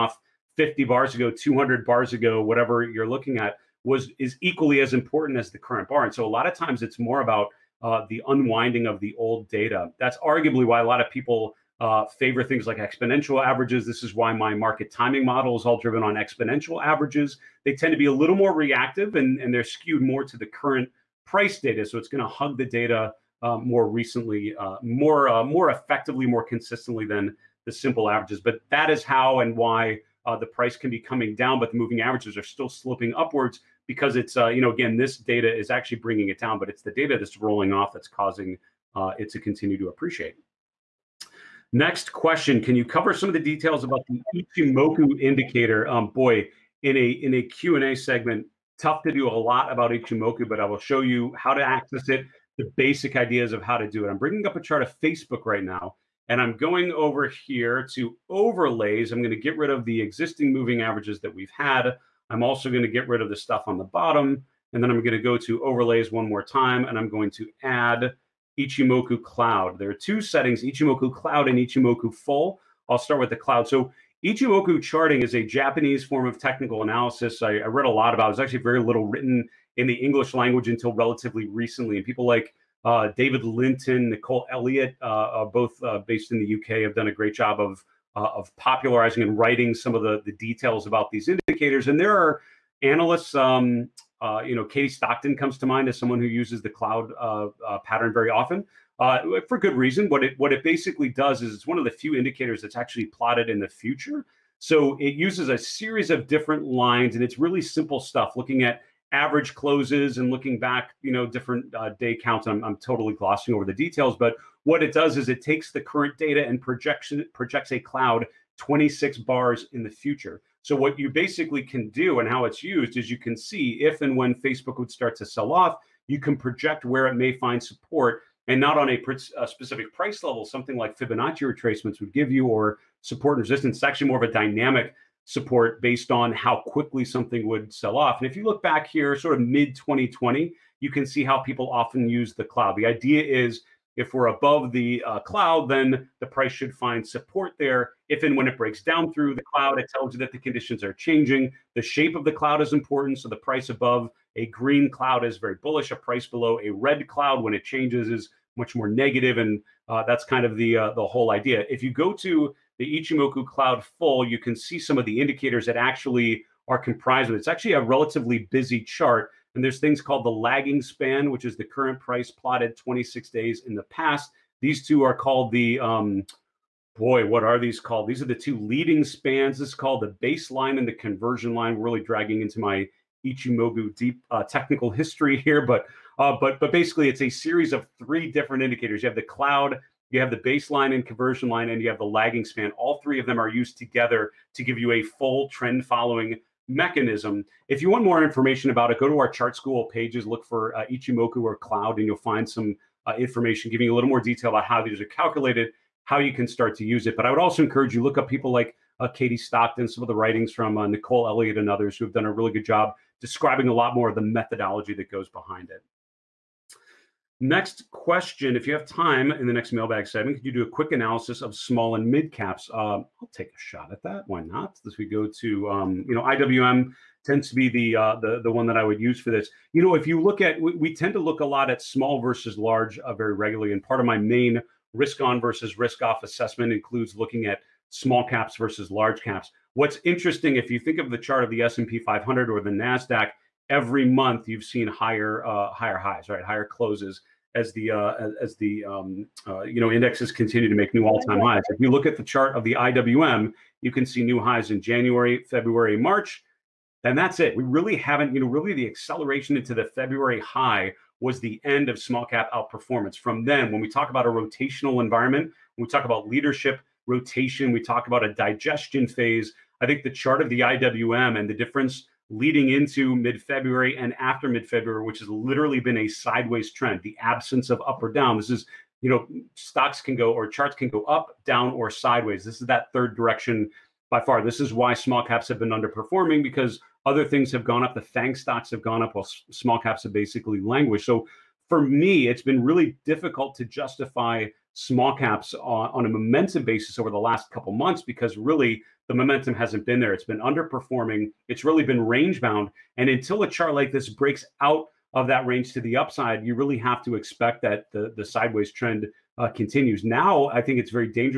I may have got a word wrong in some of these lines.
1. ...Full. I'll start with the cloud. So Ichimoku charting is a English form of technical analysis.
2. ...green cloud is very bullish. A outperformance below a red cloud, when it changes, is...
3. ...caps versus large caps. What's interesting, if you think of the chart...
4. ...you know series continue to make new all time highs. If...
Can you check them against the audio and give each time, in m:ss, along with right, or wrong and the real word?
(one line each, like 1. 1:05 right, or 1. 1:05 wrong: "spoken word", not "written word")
1. 1:12 wrong: "Japanese", not "English"
2. 2:34 wrong: "price", not "outperformance"
3. 3:58 right
4. 4:09 wrong: "indexes", not "series".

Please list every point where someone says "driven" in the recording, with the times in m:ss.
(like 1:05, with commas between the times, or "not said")
0:15.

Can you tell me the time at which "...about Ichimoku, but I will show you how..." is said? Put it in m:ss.
0:49.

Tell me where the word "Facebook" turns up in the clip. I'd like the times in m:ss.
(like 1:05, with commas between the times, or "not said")
0:55, 2:04.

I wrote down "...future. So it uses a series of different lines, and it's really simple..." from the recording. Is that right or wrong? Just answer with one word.
right.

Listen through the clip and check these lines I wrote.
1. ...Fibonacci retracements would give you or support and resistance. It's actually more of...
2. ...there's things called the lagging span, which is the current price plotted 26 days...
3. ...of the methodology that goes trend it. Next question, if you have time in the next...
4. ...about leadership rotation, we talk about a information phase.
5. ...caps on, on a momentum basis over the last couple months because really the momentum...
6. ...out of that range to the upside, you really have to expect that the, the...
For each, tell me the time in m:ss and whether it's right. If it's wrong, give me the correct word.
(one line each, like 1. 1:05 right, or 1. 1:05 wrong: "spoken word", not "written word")
1. 2:10 right
2. 2:49 right
3. 3:34 wrong: "behind", not "trend"
4. 4:26 wrong: "digestion", not "information"
5. 4:55 right
6. 5:04 right.